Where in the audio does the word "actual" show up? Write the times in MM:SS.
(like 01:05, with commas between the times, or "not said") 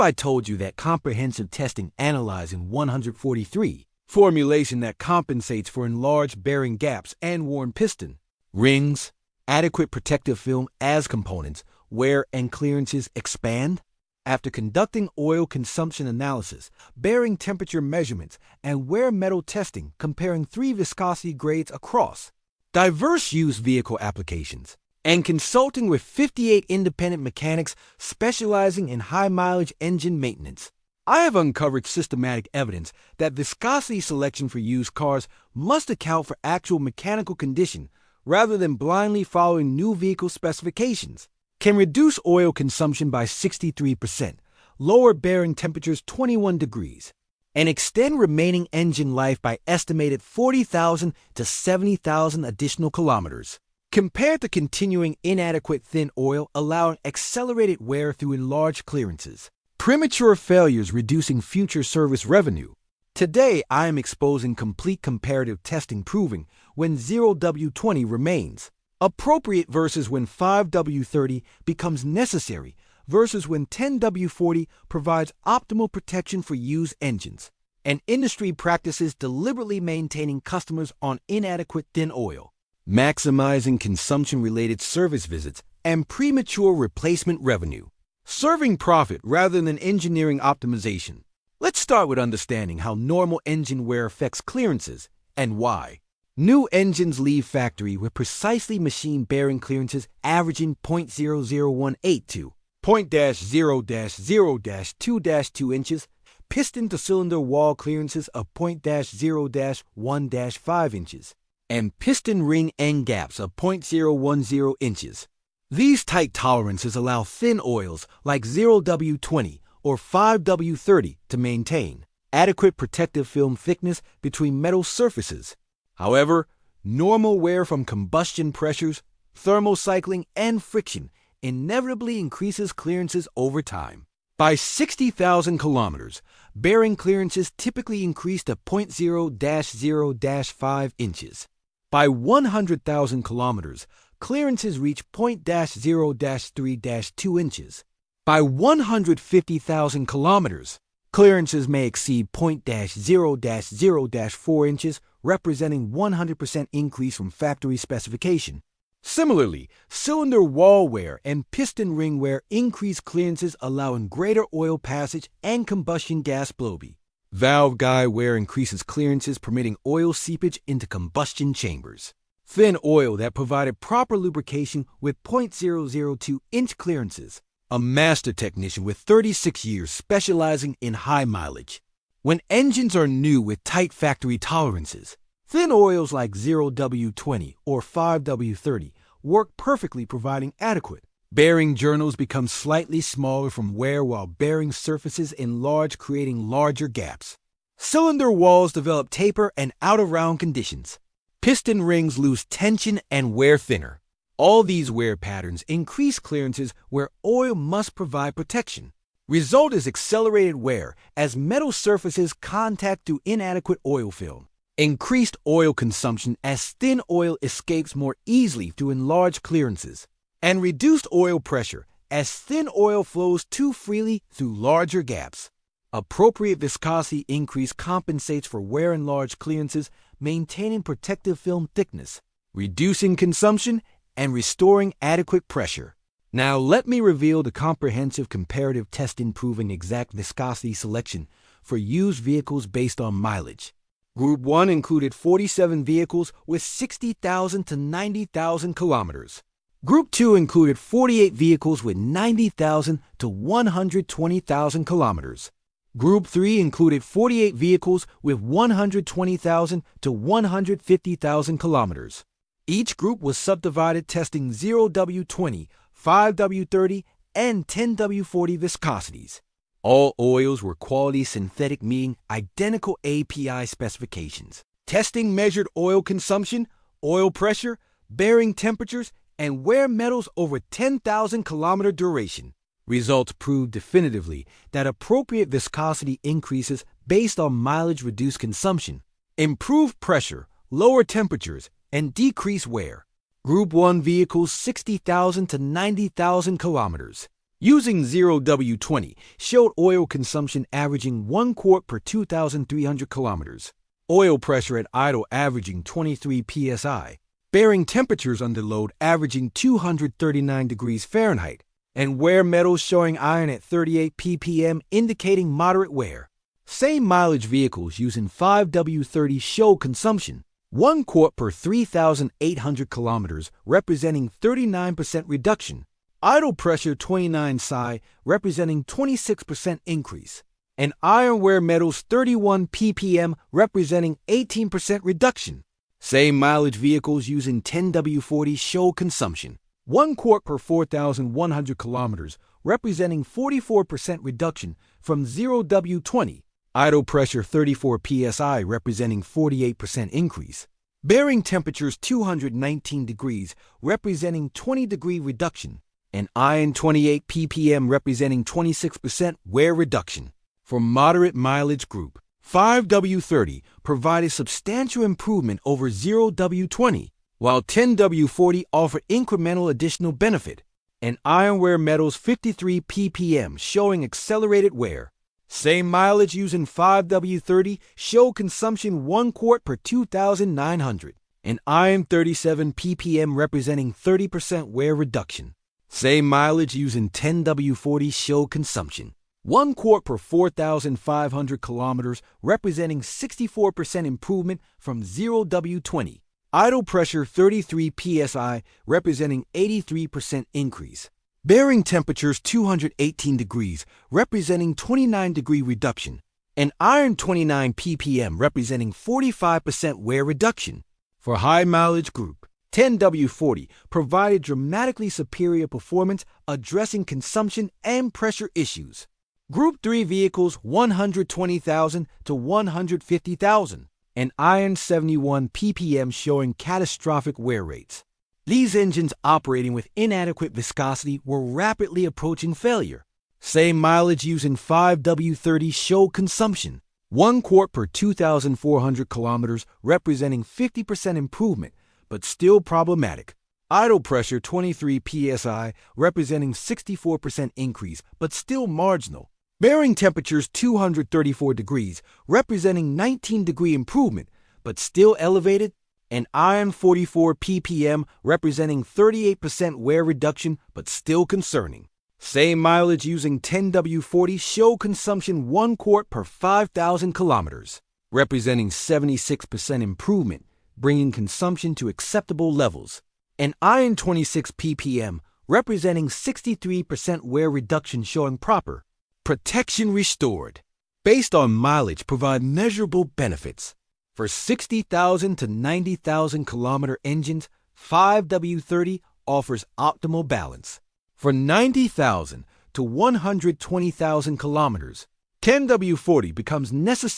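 00:36.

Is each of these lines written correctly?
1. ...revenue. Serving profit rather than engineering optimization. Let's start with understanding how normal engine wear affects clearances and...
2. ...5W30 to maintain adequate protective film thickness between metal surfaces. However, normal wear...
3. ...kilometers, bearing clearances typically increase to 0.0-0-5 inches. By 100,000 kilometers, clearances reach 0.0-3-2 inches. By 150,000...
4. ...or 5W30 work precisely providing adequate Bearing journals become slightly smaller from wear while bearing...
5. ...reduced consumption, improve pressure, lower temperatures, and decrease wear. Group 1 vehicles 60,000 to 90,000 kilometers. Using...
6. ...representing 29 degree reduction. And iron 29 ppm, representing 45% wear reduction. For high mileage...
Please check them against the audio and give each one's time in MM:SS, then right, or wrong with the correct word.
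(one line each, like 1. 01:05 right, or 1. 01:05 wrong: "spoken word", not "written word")
1. 01:27 right
2. 01:59 right
3. 02:15 right
4. 03:07 wrong: "perfectly", not "precisely"
5. 04:48 right
6. 06:44 right.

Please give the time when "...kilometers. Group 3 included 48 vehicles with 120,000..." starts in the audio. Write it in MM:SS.
04:14.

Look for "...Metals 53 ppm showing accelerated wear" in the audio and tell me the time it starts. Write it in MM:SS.
06:11.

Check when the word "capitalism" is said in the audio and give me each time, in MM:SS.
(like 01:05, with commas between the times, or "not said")
not said.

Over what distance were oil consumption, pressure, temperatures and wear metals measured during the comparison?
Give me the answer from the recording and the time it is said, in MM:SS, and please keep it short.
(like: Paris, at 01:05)
10,000 kilometers, at 04:40.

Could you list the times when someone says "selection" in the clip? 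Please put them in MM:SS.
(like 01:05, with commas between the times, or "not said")
00:33, 04:00.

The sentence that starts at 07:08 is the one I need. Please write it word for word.
These engines operating with inadequate viscosity were rapidly approaching failure.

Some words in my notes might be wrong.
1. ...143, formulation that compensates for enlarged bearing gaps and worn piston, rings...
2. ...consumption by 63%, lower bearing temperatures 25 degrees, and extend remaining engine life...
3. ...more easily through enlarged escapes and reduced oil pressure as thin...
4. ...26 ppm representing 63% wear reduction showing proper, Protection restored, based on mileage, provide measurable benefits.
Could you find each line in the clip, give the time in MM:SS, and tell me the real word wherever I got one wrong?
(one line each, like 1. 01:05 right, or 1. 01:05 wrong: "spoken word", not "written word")
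1. 00:02 right
2. 00:42 wrong: "21", not "25"
3. 03:37 wrong: "clearances", not "escapes"
4. 07:53 right.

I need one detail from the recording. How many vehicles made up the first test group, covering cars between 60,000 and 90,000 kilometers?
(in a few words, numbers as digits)
47.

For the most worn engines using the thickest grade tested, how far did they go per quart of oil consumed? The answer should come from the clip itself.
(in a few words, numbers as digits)
5,000 kilometers.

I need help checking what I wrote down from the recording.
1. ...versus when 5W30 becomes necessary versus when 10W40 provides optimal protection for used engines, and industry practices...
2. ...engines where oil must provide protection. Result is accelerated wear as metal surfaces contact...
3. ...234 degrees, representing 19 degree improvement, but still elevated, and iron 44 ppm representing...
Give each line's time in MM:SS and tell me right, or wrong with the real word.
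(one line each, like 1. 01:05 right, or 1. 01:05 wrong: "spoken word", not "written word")
1. 01:09 right
2. 03:26 wrong: "clearances", not "engines"
3. 07:30 right.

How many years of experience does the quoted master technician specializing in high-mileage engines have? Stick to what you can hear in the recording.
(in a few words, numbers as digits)
36 years.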